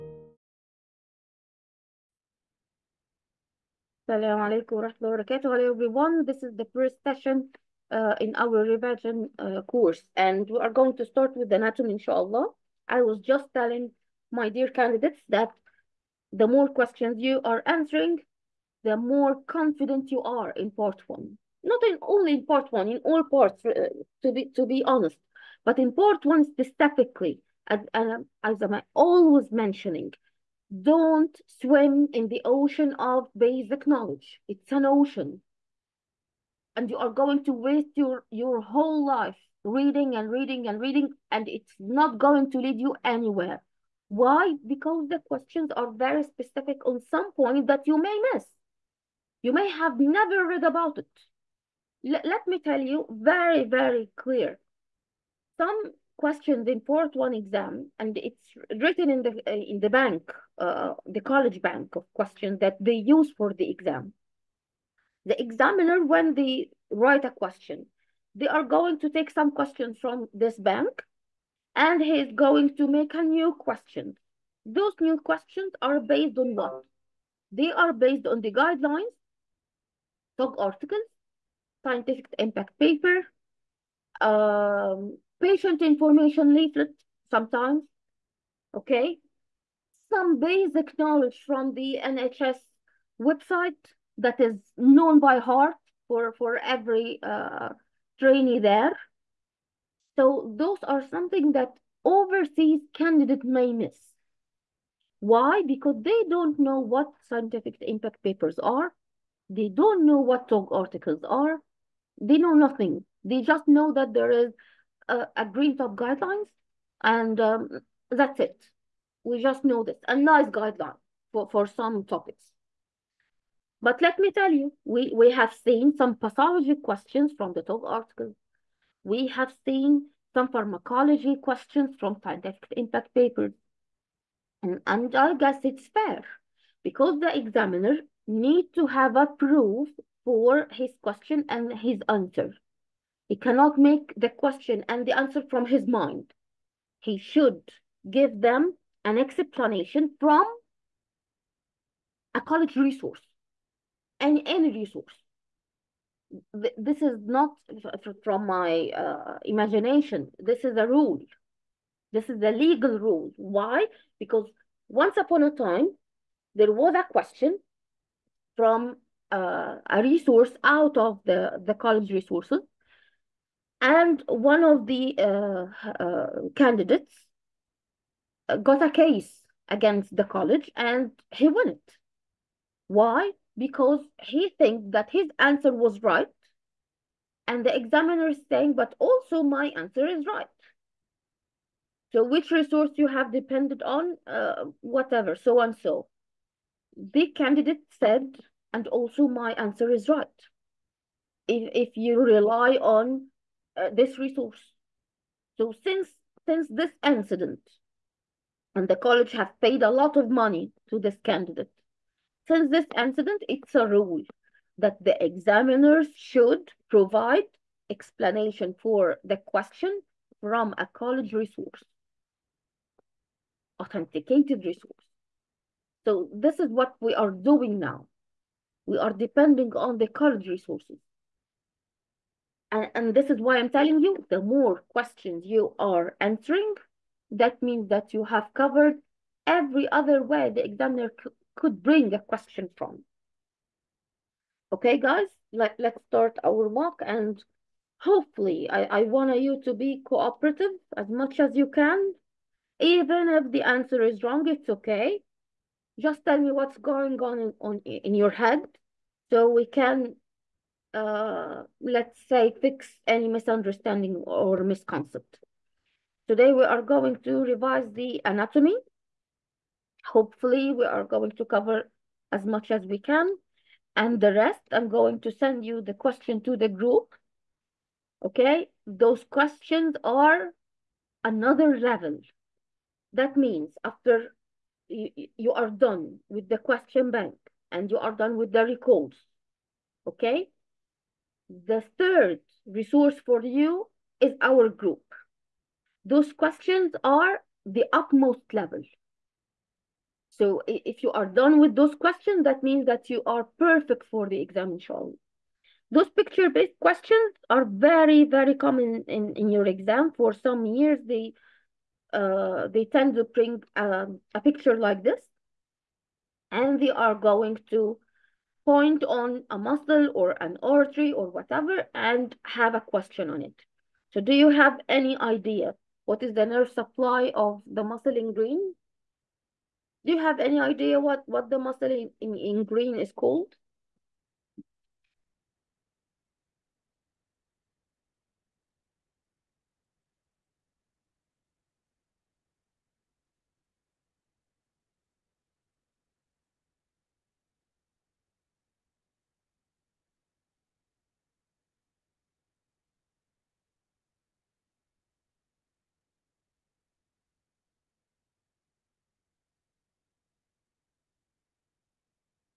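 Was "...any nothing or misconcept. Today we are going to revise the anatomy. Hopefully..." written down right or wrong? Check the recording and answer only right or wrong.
wrong.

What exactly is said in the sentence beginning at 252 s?
Even if the answer is wrong, it's okay.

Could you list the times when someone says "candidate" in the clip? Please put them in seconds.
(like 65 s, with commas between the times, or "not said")
14 s, 102 s, 176 s, 197 s, 211 s.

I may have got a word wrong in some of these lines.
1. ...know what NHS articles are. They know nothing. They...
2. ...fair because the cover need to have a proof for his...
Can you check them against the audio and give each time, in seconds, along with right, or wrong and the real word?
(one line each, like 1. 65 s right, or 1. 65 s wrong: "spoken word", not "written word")
1. 110 s wrong: "TOG", not "NHS"
2. 135 s wrong: "examiner", not "cover".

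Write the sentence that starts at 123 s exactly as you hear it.
But let me tell you, we, we have seen some pathology questions from the TOG article.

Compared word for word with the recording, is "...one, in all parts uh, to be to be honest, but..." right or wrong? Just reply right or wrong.
right.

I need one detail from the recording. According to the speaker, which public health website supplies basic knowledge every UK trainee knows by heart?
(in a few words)
NHS website.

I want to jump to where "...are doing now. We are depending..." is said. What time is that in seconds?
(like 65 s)
227 s.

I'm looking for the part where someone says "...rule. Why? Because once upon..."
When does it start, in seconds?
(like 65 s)
162 s.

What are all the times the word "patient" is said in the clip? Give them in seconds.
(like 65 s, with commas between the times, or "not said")
85 s.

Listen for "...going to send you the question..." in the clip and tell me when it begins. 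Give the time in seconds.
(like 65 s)
274 s.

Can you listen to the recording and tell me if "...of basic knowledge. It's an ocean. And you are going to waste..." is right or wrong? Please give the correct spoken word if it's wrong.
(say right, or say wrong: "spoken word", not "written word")
right.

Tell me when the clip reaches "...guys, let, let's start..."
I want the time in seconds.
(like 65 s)
244 s.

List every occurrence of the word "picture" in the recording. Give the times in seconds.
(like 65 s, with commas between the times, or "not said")
306 s, 314 s.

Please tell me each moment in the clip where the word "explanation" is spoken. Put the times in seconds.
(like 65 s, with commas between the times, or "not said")
149 s, 217 s.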